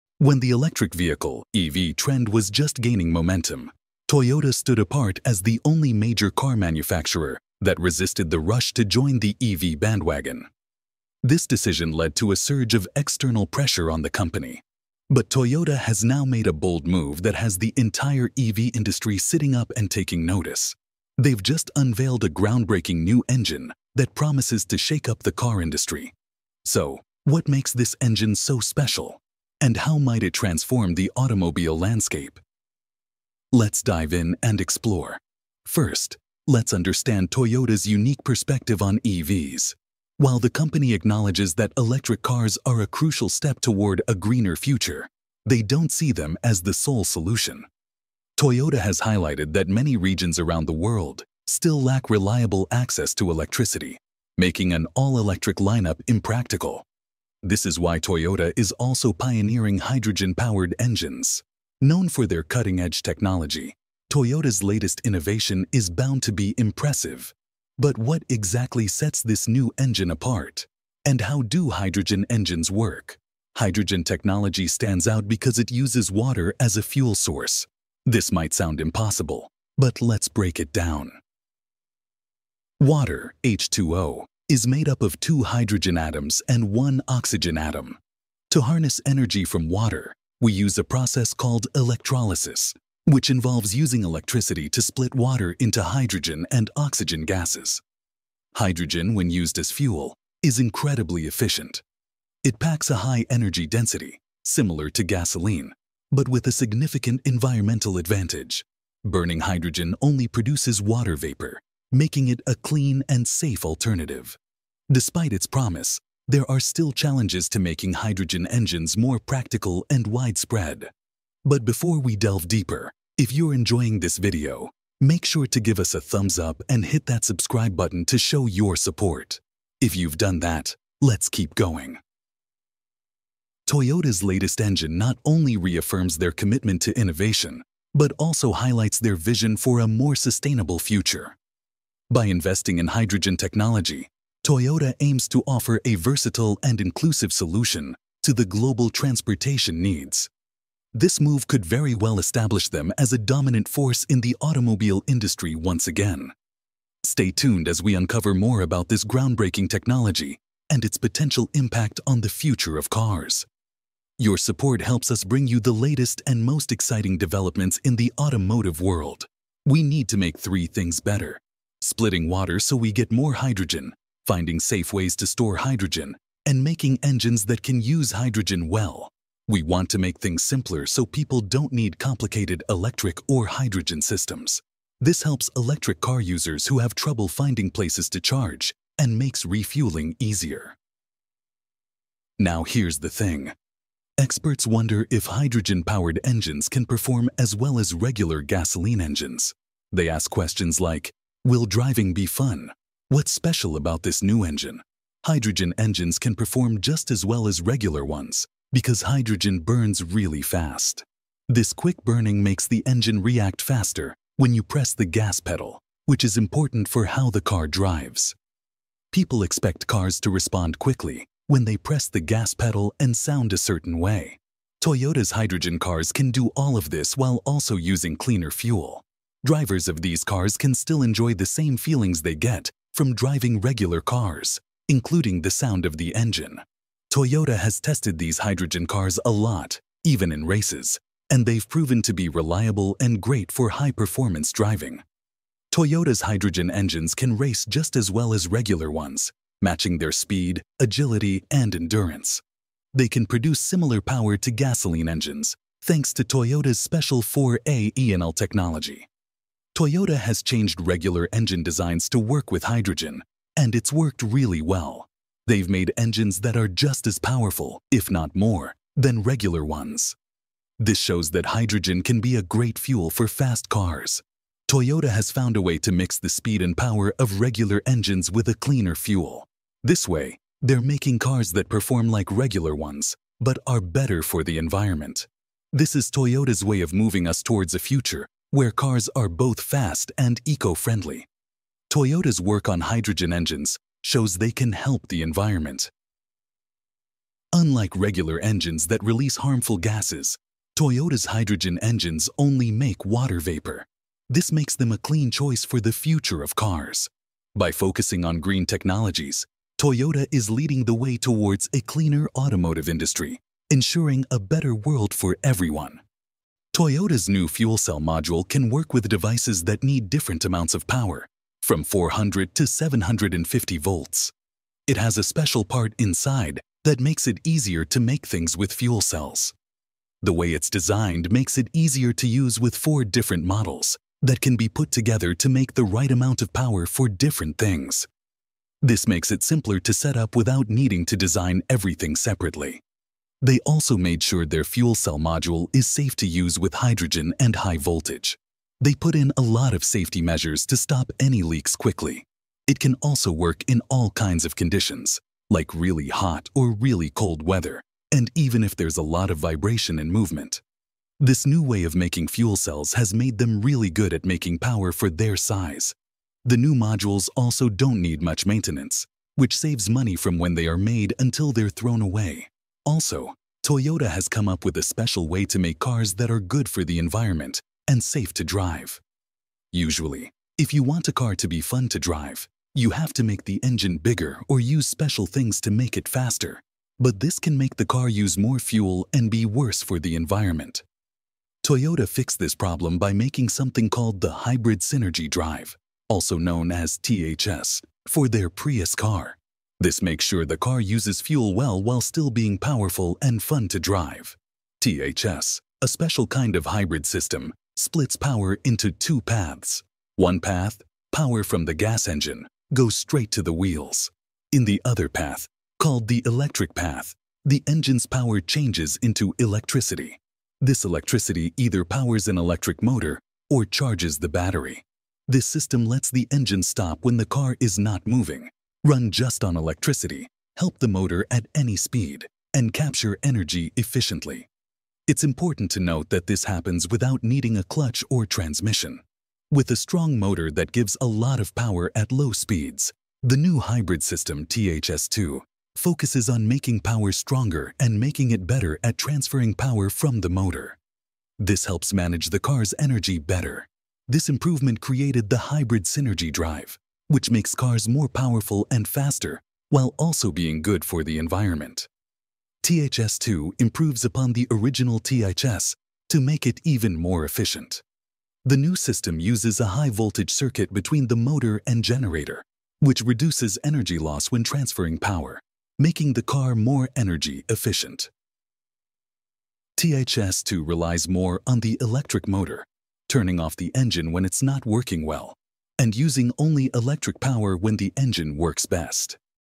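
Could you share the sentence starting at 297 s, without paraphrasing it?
Unlike regular engines that release harmful gases, Toyota's hydrogen engines only make water vapor.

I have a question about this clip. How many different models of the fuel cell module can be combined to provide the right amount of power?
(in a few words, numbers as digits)
4.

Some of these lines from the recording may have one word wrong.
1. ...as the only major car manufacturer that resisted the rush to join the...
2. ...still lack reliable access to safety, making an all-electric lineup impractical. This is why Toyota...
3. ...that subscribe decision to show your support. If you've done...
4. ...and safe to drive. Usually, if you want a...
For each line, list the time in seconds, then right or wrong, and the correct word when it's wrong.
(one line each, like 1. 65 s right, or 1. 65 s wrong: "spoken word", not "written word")
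1. 5 s right
2. 51 s wrong: "electricity", not "safety"
3. 127 s wrong: "button", not "decision"
4. 377 s right.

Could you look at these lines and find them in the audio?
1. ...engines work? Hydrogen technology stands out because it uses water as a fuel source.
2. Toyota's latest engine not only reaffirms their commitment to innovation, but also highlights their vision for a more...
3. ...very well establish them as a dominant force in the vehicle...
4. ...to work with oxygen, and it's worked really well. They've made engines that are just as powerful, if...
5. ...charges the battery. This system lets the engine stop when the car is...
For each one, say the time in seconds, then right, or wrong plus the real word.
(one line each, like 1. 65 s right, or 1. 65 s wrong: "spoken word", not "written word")
1. 72 s right
2. 133 s right
3. 151 s wrong: "automobile", not "vehicle"
4. 262 s wrong: "hydrogen", not "oxygen"
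5. 423 s right.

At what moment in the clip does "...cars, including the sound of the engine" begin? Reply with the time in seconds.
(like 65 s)
233 s.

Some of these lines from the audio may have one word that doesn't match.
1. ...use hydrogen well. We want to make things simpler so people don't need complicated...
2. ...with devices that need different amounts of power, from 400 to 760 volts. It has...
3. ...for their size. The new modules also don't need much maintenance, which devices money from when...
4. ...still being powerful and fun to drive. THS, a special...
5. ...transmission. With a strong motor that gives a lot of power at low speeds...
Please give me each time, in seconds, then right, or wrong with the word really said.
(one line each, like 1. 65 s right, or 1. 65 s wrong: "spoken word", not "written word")
1. 177 s right
2. 318 s wrong: "750", not "760"
3. 364 s wrong: "saves", not "devices"
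4. 402 s right
5. 438 s right.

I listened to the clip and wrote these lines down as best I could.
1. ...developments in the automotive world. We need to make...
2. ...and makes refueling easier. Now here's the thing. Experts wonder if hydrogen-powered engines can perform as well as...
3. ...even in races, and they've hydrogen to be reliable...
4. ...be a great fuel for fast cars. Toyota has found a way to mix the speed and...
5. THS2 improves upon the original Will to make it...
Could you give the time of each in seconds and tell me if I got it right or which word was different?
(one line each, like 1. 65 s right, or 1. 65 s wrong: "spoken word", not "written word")
1. 167 s right
2. 188 s right
3. 240 s wrong: "proven", not "hydrogen"
4. 272 s right
5. 462 s wrong: "THS", not "Will".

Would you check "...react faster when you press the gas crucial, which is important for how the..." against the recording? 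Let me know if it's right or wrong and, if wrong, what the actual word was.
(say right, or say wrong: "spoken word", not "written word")
wrong: "pedal", not "crucial".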